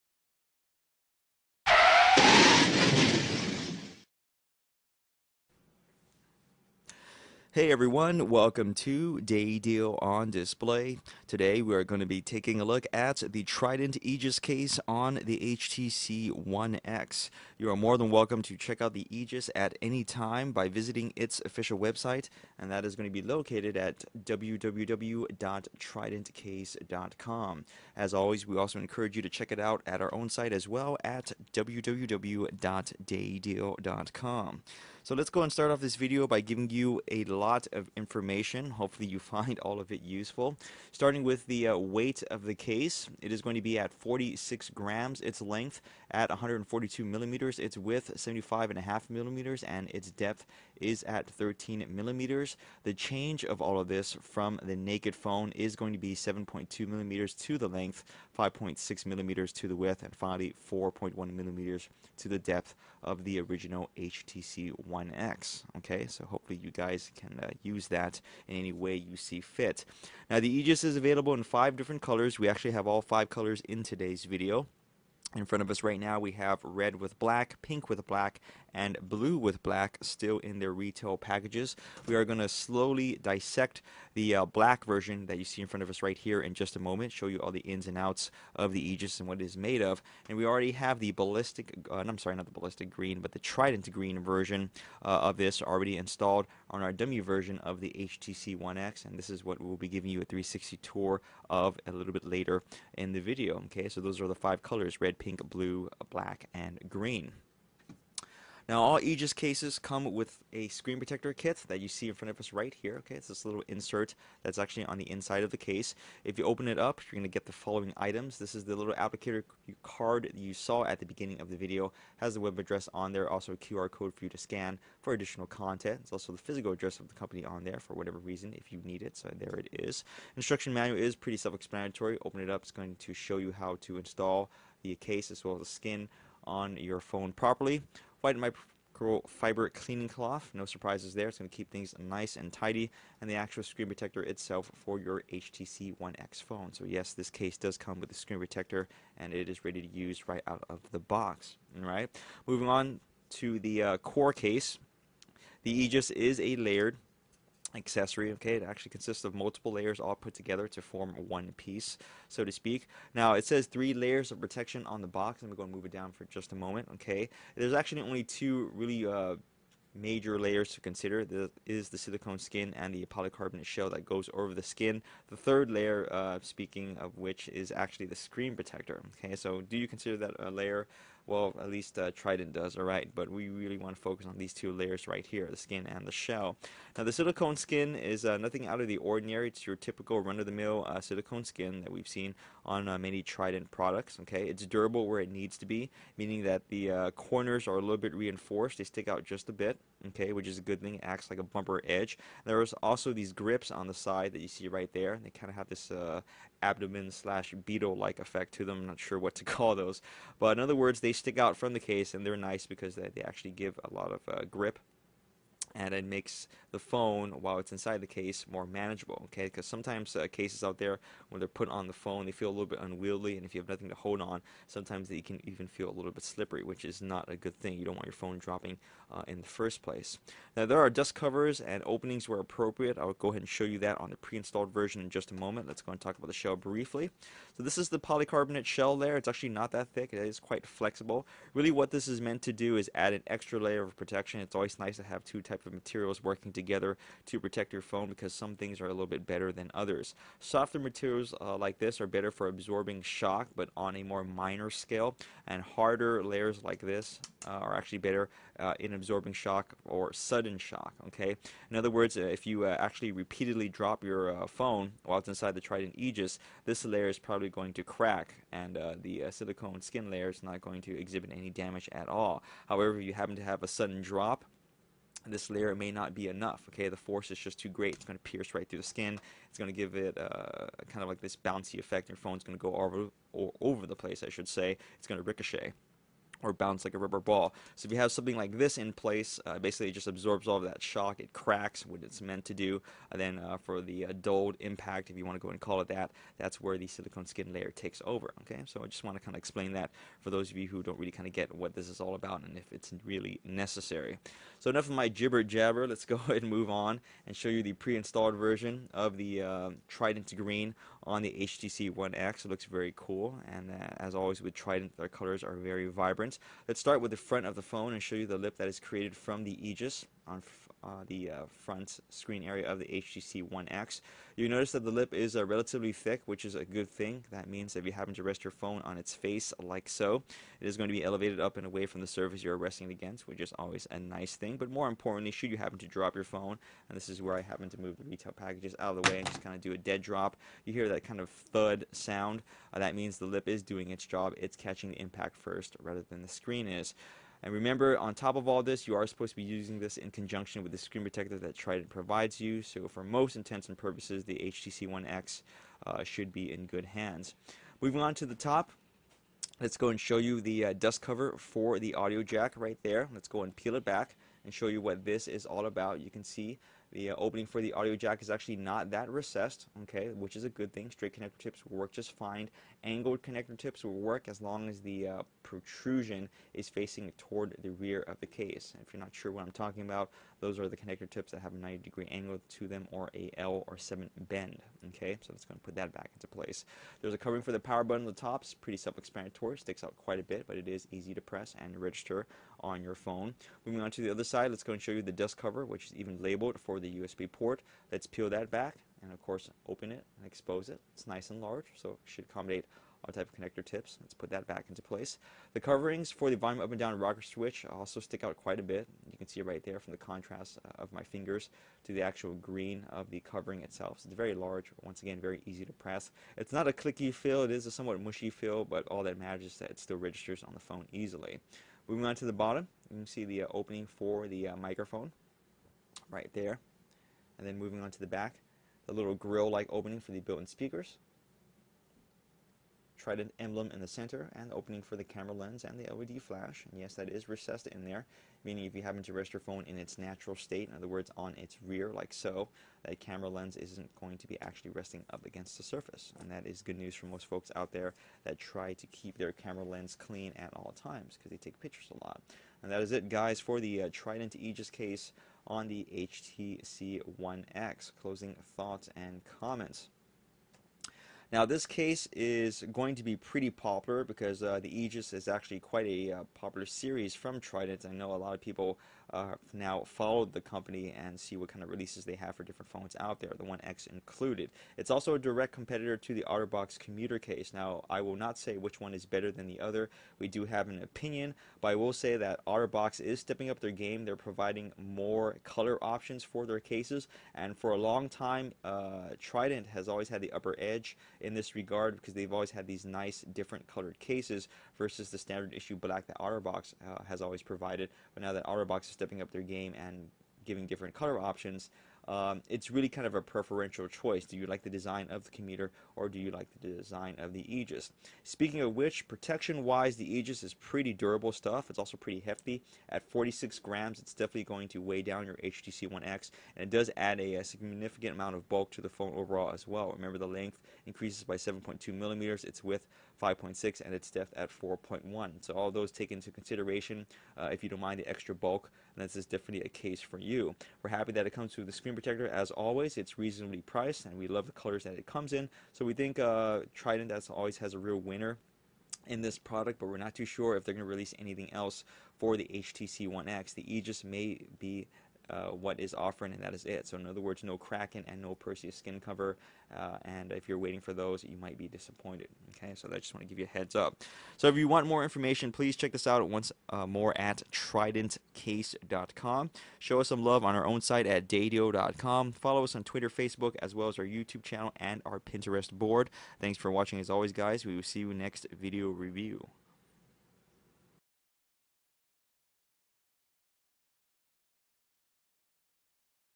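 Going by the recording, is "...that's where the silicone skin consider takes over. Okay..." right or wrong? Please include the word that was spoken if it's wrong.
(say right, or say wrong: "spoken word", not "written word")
wrong: "layer", not "consider".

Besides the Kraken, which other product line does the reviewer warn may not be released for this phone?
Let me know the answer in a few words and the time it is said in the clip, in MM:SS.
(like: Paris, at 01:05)
Perseus, at 09:08.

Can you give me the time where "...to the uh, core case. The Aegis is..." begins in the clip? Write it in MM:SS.
02:33.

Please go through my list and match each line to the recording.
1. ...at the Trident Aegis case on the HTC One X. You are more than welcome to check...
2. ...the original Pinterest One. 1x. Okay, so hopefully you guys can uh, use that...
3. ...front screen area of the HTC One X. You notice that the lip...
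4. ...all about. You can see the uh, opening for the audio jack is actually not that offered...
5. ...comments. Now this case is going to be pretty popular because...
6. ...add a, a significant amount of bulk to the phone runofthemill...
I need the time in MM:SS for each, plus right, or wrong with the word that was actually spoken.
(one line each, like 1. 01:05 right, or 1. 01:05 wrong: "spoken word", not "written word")
1. 00:12 right
2. 01:03 wrong: "HTC", not "Pinterest"
3. 05:21 right
4. 06:05 wrong: "recessed", not "offered"
5. 07:39 right
6. 08:36 wrong: "overall", not "runofthemill".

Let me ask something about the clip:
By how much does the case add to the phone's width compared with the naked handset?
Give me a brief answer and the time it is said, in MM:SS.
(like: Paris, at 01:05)
5.6 millimeters, at 00:58.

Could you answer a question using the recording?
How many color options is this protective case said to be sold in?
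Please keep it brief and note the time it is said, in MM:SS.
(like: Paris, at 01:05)
5, at 01:11.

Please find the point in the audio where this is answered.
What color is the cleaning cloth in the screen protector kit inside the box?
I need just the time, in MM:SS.
02:18.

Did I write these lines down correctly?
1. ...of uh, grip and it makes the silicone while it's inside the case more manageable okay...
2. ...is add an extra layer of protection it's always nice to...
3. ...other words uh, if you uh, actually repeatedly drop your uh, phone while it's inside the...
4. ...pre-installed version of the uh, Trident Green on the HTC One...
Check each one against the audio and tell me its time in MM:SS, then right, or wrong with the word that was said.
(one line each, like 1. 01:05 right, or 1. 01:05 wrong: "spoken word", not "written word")
1. 03:34 wrong: "phone", not "silicone"
2. 04:02 right
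3. 04:21 right
4. 05:07 right.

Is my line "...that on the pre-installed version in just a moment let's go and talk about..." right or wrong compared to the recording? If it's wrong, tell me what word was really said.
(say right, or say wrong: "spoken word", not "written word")
right.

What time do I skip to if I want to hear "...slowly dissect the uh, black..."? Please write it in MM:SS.
01:22.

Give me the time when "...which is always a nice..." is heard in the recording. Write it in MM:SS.
05:33.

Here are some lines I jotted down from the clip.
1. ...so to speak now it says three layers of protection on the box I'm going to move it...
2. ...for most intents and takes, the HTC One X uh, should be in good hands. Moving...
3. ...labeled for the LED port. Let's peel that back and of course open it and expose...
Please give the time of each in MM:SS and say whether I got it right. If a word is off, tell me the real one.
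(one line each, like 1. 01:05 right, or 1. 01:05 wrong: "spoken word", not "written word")
1. 02:42 right
2. 05:52 wrong: "purposes", not "takes"
3. 06:36 wrong: "USB", not "LED".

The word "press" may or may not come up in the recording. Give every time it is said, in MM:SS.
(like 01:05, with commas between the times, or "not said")
06:31, 06:55.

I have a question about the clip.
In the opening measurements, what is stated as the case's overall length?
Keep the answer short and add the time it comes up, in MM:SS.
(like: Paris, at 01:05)
142 millimeters, at 00:46.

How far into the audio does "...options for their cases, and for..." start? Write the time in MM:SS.
08:05.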